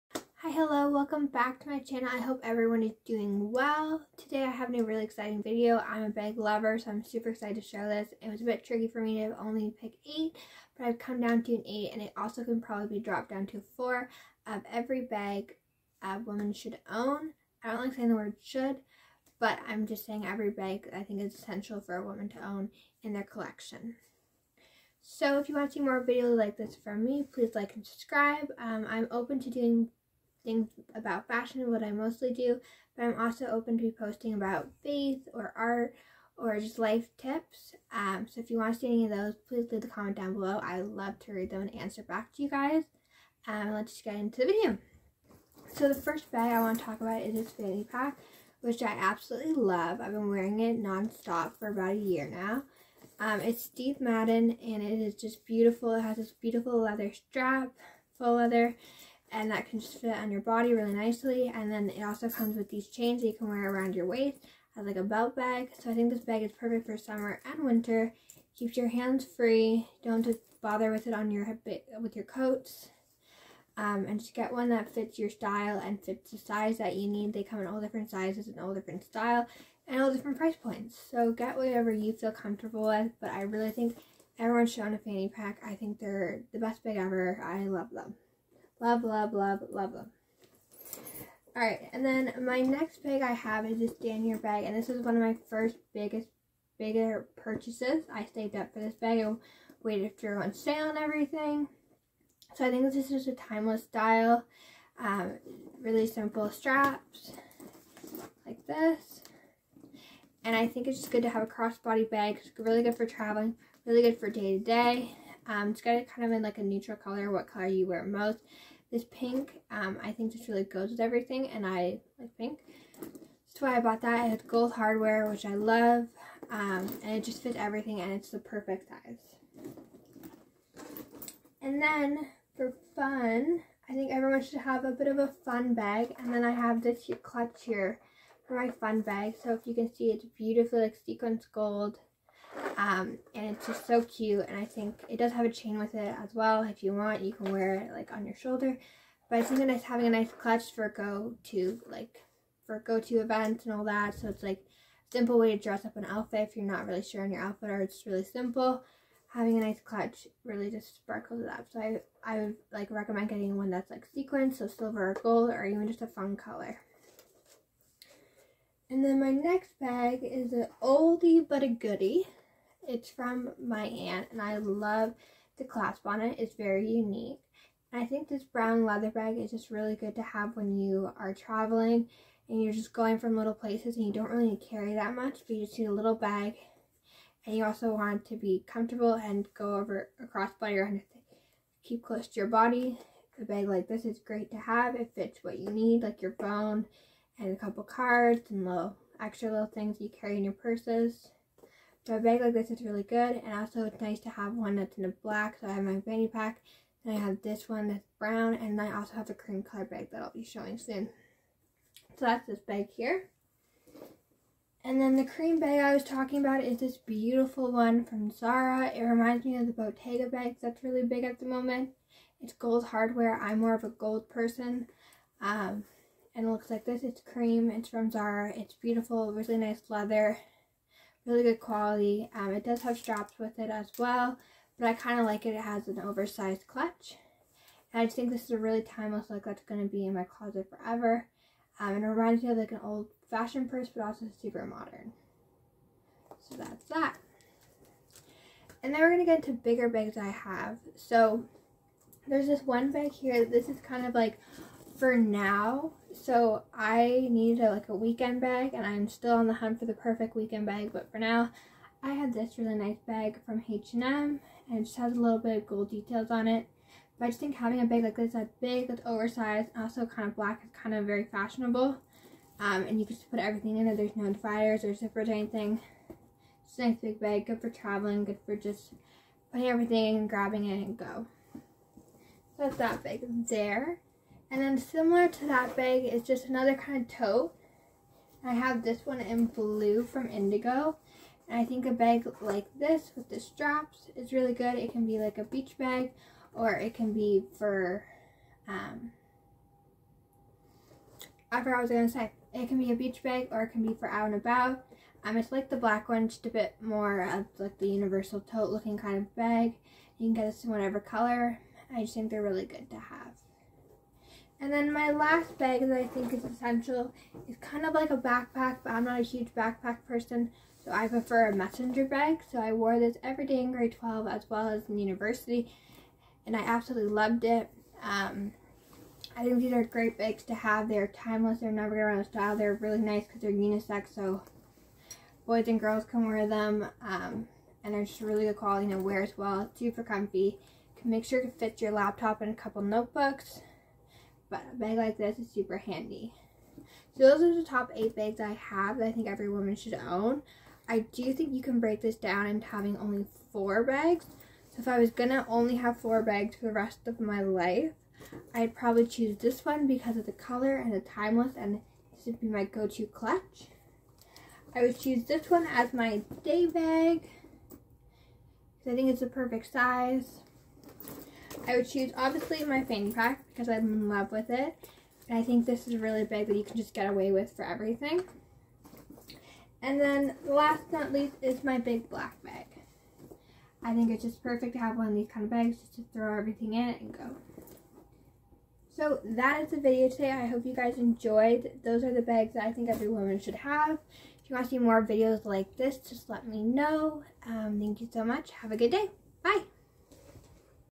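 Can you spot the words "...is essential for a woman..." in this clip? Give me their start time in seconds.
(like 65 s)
21 s.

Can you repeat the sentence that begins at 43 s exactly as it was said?
Um, let's just get into the video.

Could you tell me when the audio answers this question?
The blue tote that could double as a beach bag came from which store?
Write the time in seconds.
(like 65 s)
290 s.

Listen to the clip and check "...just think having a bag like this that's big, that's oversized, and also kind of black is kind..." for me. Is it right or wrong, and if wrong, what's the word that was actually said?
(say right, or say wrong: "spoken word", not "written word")
right.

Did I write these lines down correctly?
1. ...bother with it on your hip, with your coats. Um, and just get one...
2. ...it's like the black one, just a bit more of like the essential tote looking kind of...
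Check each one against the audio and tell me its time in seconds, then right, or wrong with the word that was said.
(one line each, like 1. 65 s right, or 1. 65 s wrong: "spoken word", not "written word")
1. 70 s right
2. 305 s wrong: "universal", not "essential".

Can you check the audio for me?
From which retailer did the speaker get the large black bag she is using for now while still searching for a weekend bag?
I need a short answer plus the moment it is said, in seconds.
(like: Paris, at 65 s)
H&M, at 263 s.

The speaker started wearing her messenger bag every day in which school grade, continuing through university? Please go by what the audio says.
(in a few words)
grade 12.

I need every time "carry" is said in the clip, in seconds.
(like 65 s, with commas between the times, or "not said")
184 s, 200 s.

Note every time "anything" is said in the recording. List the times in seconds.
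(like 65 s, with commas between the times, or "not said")
190 s, 275 s.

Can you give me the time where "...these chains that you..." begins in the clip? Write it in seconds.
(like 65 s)
62 s.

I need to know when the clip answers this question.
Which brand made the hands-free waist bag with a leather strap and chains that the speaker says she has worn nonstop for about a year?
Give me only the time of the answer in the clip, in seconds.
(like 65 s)
53 s.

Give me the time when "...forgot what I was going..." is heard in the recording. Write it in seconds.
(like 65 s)
301 s.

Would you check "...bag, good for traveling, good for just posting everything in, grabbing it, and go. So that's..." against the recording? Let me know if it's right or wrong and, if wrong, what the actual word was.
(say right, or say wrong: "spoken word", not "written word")
wrong: "putting", not "posting".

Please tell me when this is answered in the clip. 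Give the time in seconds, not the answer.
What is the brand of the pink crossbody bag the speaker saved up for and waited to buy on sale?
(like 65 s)
94 s.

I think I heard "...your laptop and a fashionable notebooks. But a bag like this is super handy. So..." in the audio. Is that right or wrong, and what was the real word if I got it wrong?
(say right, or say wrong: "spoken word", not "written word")
wrong: "couple", not "fashionable".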